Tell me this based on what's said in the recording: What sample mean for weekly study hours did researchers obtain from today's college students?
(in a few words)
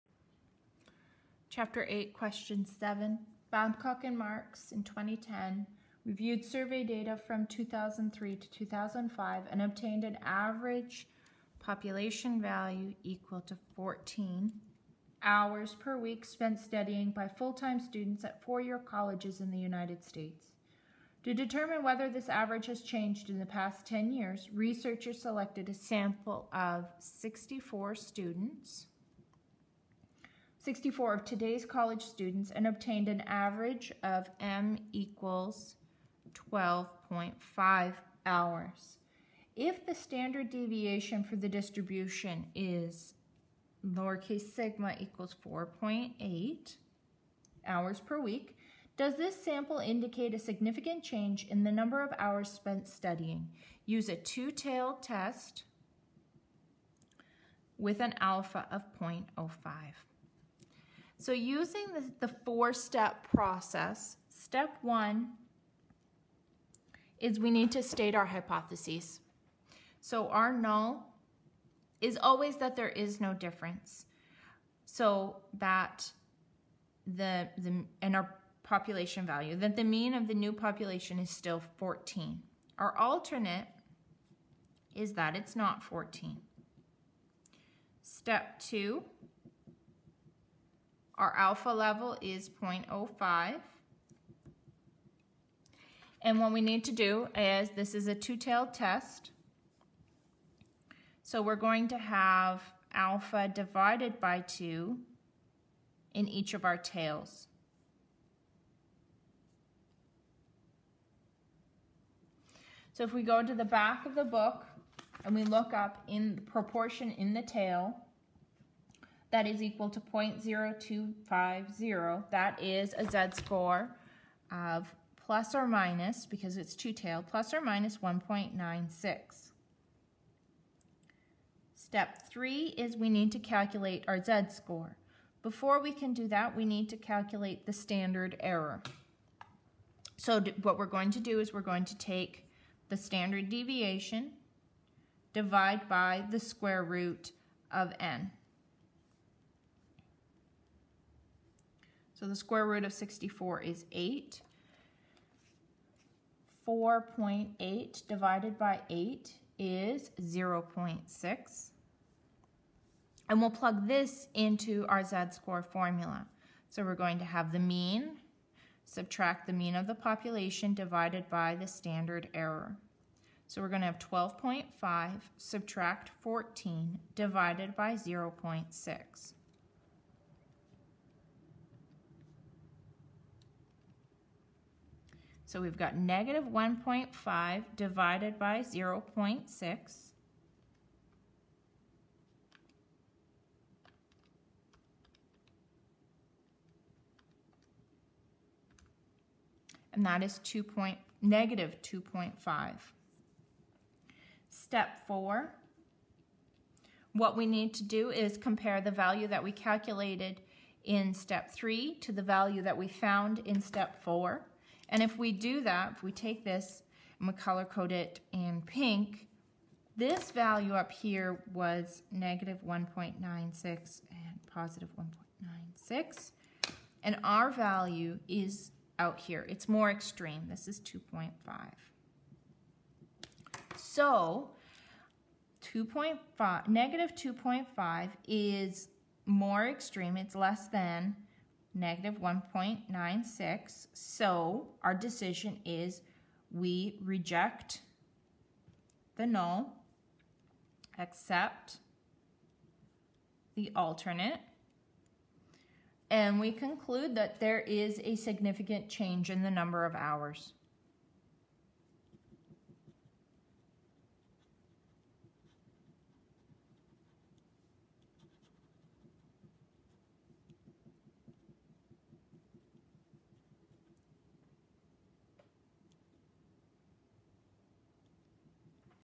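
12.5 hours.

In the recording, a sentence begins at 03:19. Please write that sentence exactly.
And that is 2 point, negative 2.5.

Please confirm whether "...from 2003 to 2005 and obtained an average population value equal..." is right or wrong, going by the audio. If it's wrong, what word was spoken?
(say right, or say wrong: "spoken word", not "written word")
right.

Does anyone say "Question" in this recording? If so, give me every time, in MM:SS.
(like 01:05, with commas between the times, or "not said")
00:02.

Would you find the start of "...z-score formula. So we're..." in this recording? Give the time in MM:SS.
02:45.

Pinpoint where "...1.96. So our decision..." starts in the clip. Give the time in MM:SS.
04:02.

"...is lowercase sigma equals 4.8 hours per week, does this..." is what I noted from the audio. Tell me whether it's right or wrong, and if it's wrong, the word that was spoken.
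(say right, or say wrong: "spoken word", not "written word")
right.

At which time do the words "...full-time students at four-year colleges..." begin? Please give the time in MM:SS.
00:17.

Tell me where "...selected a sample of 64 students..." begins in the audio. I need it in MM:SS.
00:25.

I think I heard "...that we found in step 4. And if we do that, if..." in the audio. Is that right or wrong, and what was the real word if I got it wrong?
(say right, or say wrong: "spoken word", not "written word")
right.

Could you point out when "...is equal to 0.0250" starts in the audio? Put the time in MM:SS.
01:59.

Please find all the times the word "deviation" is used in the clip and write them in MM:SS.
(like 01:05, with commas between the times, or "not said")
00:40, 02:23.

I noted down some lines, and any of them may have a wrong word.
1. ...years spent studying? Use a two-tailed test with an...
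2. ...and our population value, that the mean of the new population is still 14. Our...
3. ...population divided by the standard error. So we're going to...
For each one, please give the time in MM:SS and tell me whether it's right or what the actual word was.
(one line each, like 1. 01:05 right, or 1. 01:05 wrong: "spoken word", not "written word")
1. 00:52 wrong: "hours", not "years"
2. 01:18 right
3. 02:49 right.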